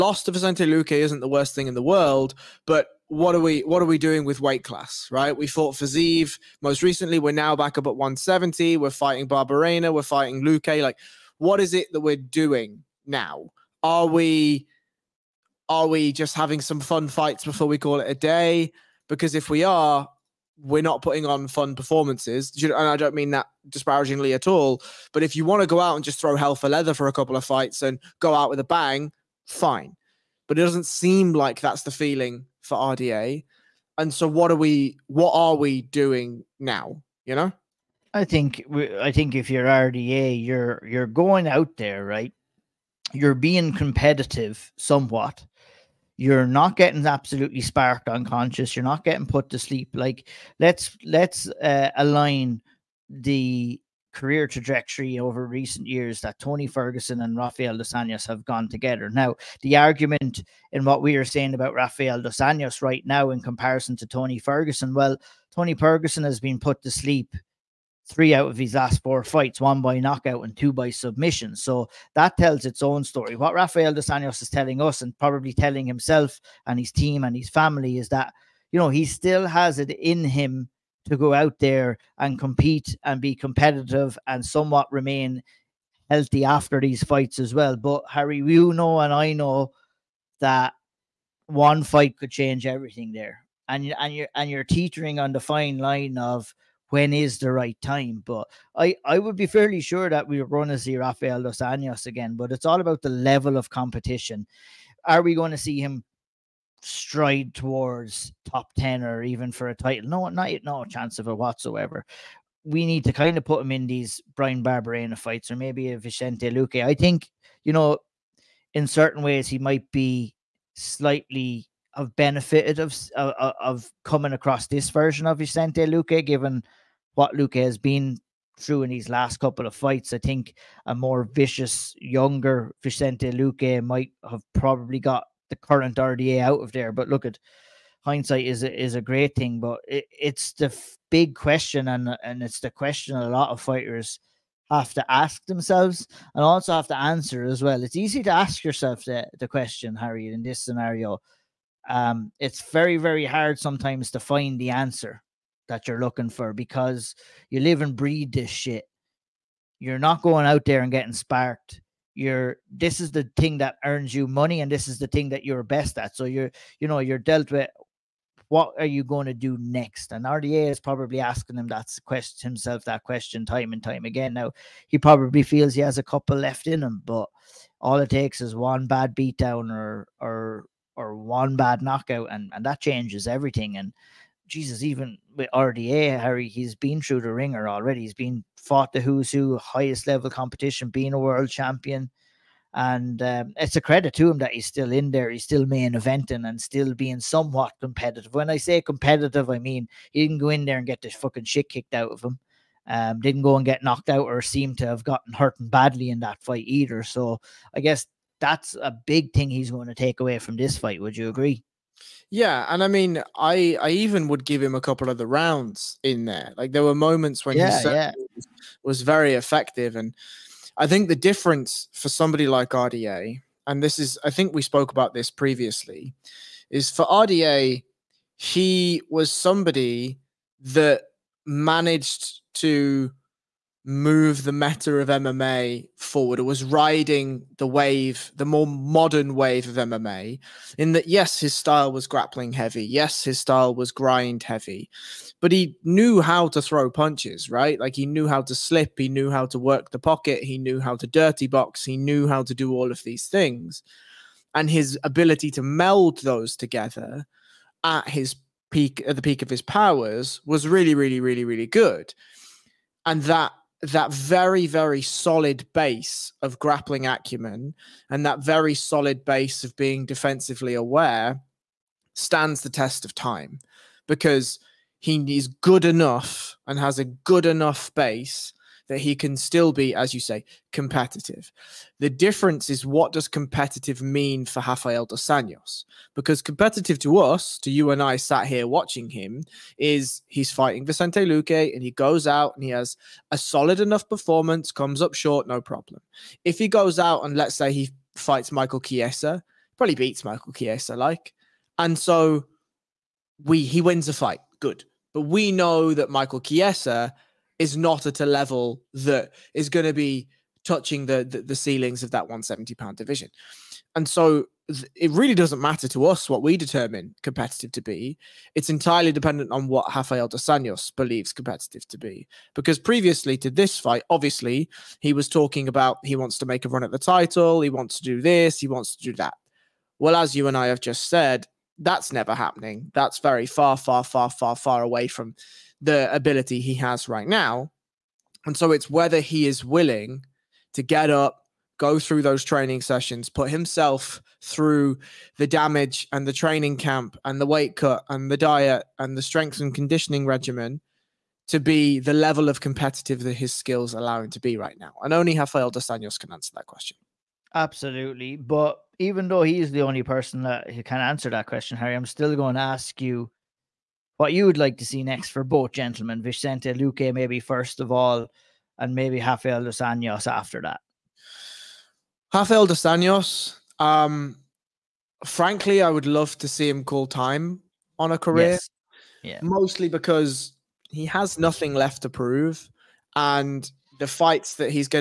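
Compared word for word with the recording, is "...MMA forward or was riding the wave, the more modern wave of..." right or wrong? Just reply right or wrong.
right.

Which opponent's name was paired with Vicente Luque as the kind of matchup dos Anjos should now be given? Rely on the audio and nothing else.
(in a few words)
Bryan Barberena.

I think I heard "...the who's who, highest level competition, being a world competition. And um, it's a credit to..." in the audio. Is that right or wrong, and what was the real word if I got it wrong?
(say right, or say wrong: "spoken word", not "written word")
wrong: "champion", not "competition".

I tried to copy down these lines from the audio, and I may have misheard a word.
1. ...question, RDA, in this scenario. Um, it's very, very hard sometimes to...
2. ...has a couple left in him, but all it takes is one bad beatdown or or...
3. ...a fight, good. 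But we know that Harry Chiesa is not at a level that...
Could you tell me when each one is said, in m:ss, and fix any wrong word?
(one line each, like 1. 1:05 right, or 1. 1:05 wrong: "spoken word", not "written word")
1. 2:29 wrong: "Harry", not "RDA"
2. 2:55 right
3. 5:04 wrong: "Michael", not "Harry".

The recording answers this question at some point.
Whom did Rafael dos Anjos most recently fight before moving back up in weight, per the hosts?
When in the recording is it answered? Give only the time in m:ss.
0:05.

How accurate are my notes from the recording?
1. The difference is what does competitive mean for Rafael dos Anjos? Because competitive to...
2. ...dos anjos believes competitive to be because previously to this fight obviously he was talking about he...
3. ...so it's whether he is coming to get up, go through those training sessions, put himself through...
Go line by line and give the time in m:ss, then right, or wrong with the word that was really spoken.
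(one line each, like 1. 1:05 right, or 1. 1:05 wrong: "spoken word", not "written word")
1. 4:41 right
2. 5:20 right
3. 5:38 wrong: "willing", not "coming".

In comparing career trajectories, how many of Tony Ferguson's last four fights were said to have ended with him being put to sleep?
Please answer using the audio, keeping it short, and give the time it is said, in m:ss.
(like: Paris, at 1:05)
3, at 1:08.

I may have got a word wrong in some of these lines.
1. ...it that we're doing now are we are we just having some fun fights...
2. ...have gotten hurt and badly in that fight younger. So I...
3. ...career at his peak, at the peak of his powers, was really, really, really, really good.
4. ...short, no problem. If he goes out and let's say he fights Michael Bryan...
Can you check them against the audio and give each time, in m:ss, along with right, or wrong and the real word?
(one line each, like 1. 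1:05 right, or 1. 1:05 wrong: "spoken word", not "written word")
1. 0:11 right
2. 3:24 wrong: "either", not "younger"
3. 4:16 wrong: "together", not "career"
4. 4:55 wrong: "Chiesa", not "Bryan".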